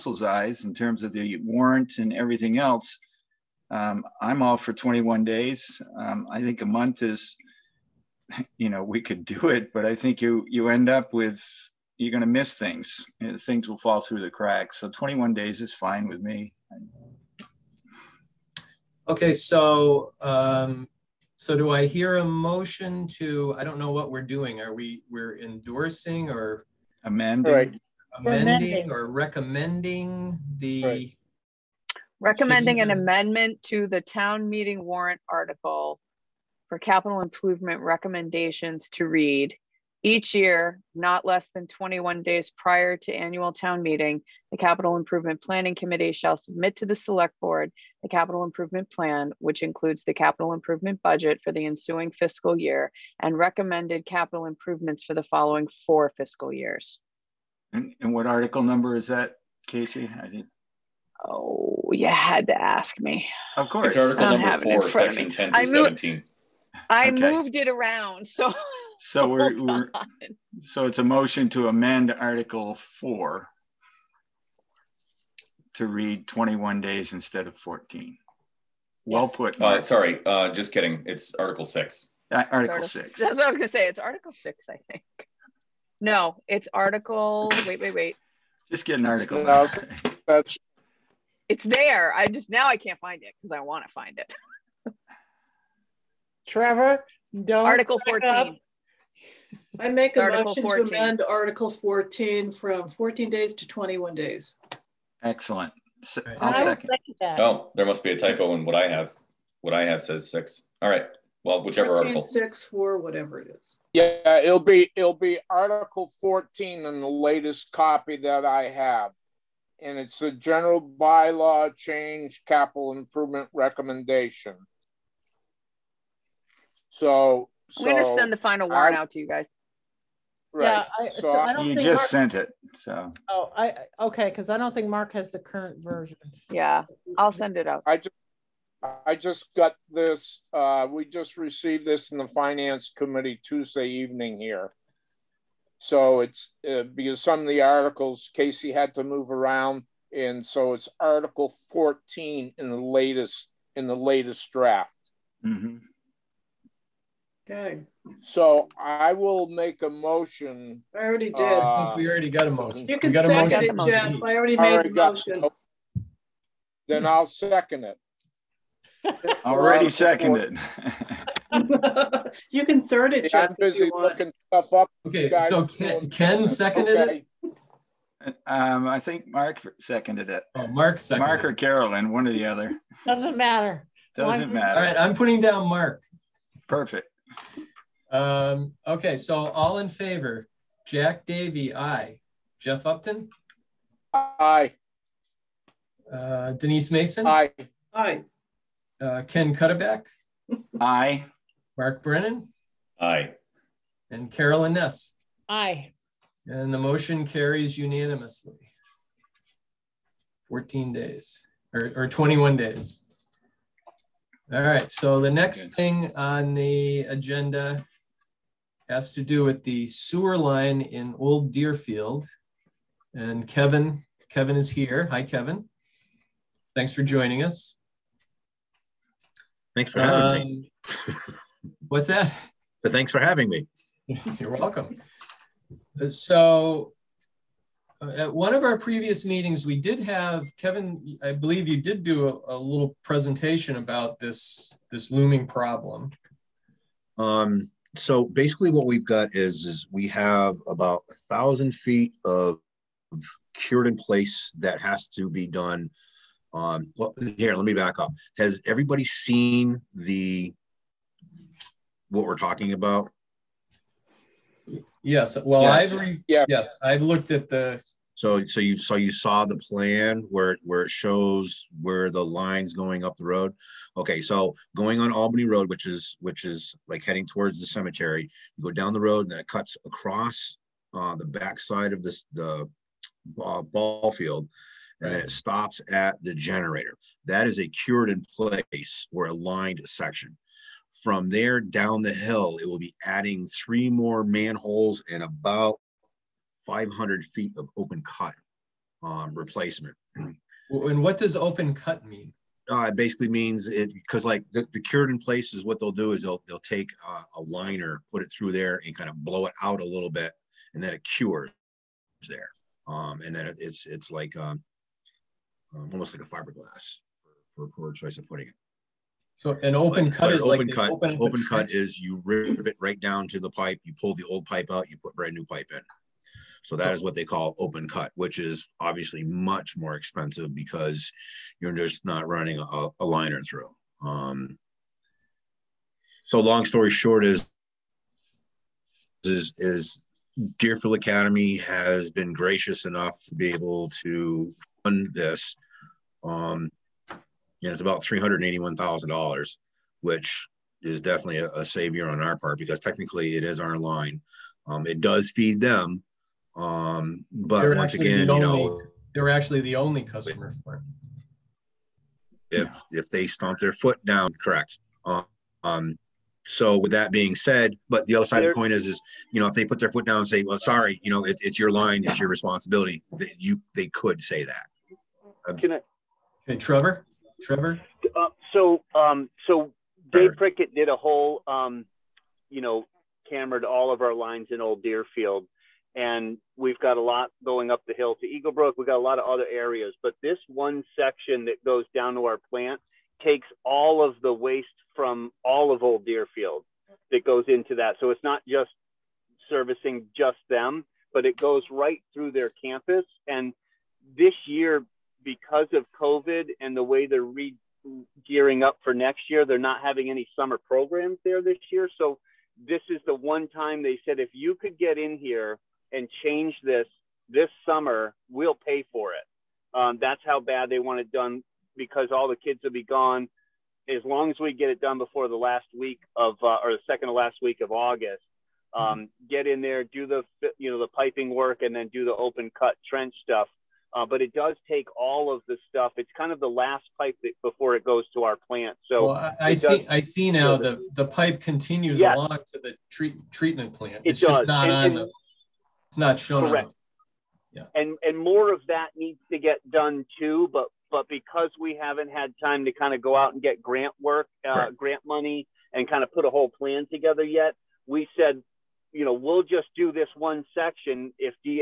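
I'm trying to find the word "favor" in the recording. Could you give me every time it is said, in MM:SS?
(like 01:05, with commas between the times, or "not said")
03:09.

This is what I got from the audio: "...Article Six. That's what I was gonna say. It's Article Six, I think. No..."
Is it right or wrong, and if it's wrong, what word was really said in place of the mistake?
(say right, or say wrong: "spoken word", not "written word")
right.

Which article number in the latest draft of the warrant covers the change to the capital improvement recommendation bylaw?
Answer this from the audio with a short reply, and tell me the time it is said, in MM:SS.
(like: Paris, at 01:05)
Article 14, at 02:30.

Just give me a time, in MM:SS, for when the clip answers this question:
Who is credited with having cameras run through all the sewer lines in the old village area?
06:20.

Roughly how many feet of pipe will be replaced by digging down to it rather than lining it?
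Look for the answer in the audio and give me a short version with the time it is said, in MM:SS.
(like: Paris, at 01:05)
500 feet, at 04:55.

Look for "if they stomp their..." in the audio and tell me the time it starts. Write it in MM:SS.
06:02.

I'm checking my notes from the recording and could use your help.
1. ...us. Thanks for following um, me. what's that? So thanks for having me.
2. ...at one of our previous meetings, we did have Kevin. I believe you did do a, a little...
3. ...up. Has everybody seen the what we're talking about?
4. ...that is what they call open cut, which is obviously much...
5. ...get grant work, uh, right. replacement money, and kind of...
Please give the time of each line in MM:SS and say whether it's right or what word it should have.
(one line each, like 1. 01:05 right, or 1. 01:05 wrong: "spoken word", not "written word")
1. 03:47 wrong: "having", not "following"
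2. 03:58 right
3. 04:17 right
4. 05:26 right
5. 07:33 wrong: "grant", not "replacement".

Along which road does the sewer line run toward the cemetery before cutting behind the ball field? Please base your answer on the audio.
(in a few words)
Albany Road.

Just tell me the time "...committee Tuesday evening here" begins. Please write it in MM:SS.
02:22.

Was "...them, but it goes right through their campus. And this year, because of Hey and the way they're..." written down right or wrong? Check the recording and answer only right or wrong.
wrong.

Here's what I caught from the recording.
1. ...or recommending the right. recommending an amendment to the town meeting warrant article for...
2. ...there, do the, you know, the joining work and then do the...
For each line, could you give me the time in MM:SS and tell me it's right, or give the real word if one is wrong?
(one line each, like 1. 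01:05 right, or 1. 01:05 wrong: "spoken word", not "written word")
1. 00:28 right
2. 07:09 wrong: "piping", not "joining".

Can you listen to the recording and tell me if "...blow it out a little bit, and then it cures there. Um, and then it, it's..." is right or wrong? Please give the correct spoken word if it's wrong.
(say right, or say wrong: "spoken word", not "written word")
right.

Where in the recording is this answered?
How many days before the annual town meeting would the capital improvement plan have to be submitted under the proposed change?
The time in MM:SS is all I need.
00:40.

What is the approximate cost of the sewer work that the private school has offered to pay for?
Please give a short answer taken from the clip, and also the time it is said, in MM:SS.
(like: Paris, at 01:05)
$381,000, at 05:47.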